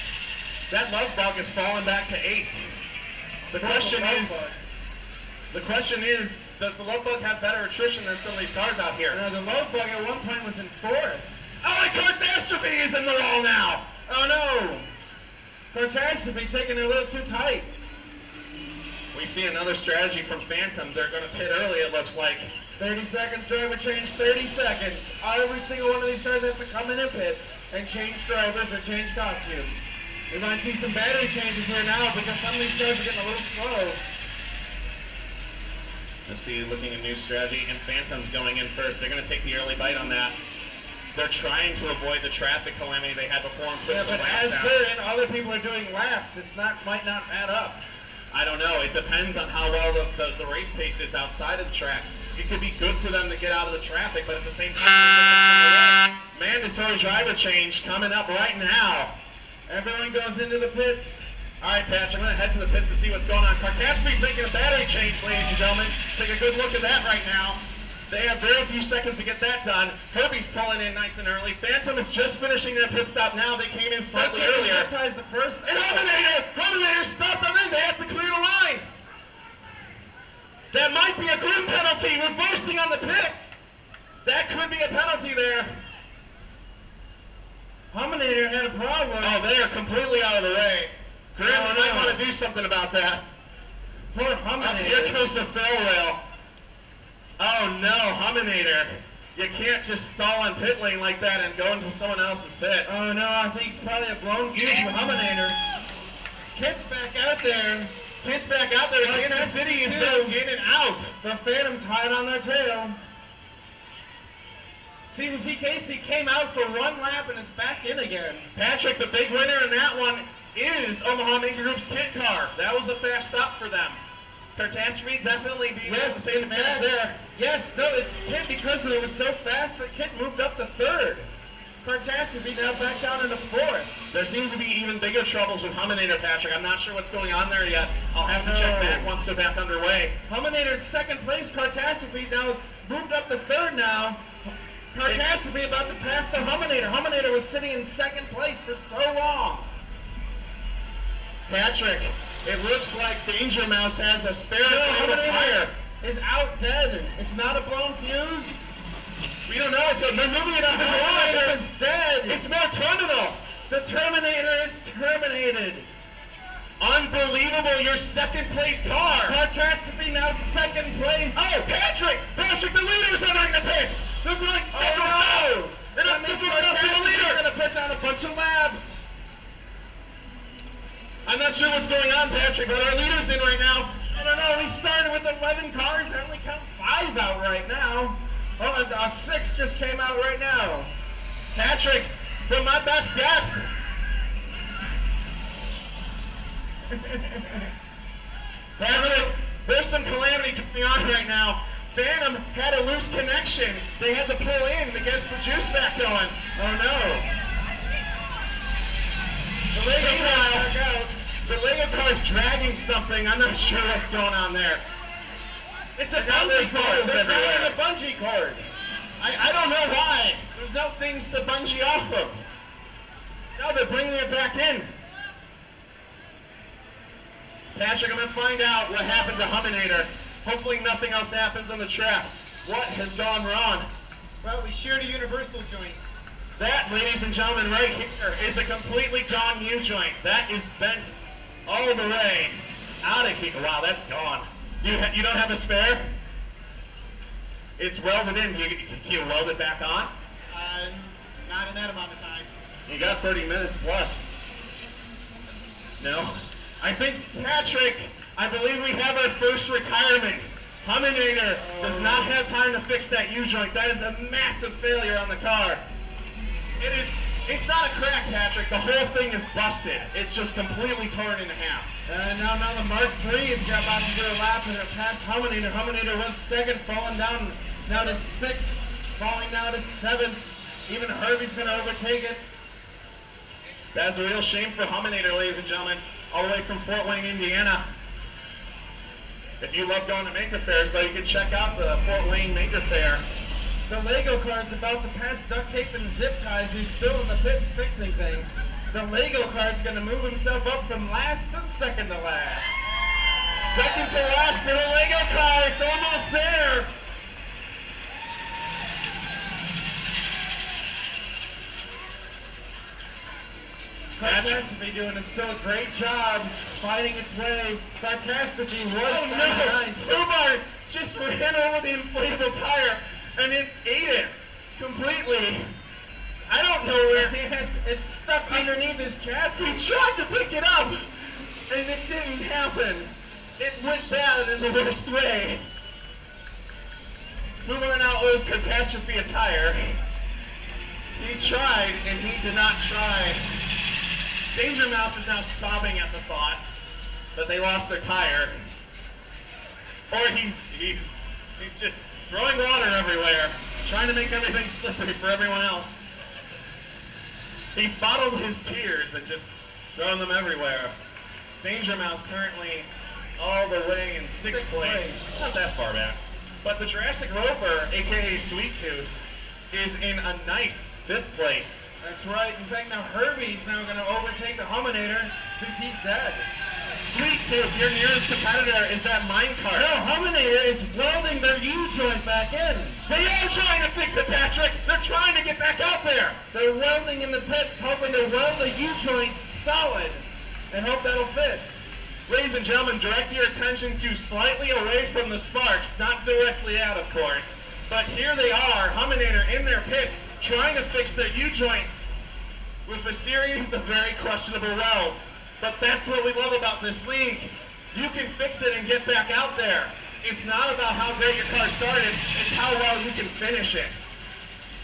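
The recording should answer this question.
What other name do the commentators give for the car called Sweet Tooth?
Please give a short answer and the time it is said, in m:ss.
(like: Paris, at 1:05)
Jurassic Rover, at 6:06.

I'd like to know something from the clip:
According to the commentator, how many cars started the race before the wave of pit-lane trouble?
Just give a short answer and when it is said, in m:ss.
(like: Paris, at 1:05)
11, at 3:05.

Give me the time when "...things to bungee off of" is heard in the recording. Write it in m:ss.
3:40.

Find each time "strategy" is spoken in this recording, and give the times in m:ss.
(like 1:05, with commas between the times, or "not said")
0:19, 0:37.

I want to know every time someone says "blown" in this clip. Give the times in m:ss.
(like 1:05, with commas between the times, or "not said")
1:44, 2:37.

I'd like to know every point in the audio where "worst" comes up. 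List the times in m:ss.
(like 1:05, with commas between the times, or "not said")
5:34.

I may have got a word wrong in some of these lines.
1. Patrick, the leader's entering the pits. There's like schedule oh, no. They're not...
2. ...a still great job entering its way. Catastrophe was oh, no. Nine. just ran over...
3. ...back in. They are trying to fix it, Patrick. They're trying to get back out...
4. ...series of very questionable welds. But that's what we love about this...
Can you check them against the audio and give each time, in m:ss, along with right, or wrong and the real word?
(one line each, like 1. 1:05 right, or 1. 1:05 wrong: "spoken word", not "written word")
1. 2:52 right
2. 5:15 wrong: "fighting", not "entering"
3. 6:22 right
4. 6:43 right.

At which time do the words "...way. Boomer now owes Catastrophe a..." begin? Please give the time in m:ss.
5:35.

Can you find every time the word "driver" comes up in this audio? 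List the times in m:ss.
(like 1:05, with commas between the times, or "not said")
0:23, 0:28, 0:56.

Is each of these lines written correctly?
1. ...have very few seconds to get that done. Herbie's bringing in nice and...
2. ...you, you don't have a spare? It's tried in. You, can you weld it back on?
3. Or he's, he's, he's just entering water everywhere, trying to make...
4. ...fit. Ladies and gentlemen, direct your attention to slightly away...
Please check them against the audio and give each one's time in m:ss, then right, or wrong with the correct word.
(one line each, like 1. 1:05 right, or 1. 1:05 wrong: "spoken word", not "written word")
1. 1:08 wrong: "pulling", not "bringing"
2. 4:04 wrong: "welded", not "tried"
3. 5:50 wrong: "throwing", not "entering"
4. 6:31 right.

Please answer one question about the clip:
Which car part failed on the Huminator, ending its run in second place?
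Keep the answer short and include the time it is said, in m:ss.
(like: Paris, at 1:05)
Universal joint, at 3:55.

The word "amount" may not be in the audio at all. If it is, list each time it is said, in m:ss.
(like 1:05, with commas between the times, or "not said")
4:11.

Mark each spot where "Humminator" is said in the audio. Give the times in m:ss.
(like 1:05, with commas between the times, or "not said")
4:20, 6:38.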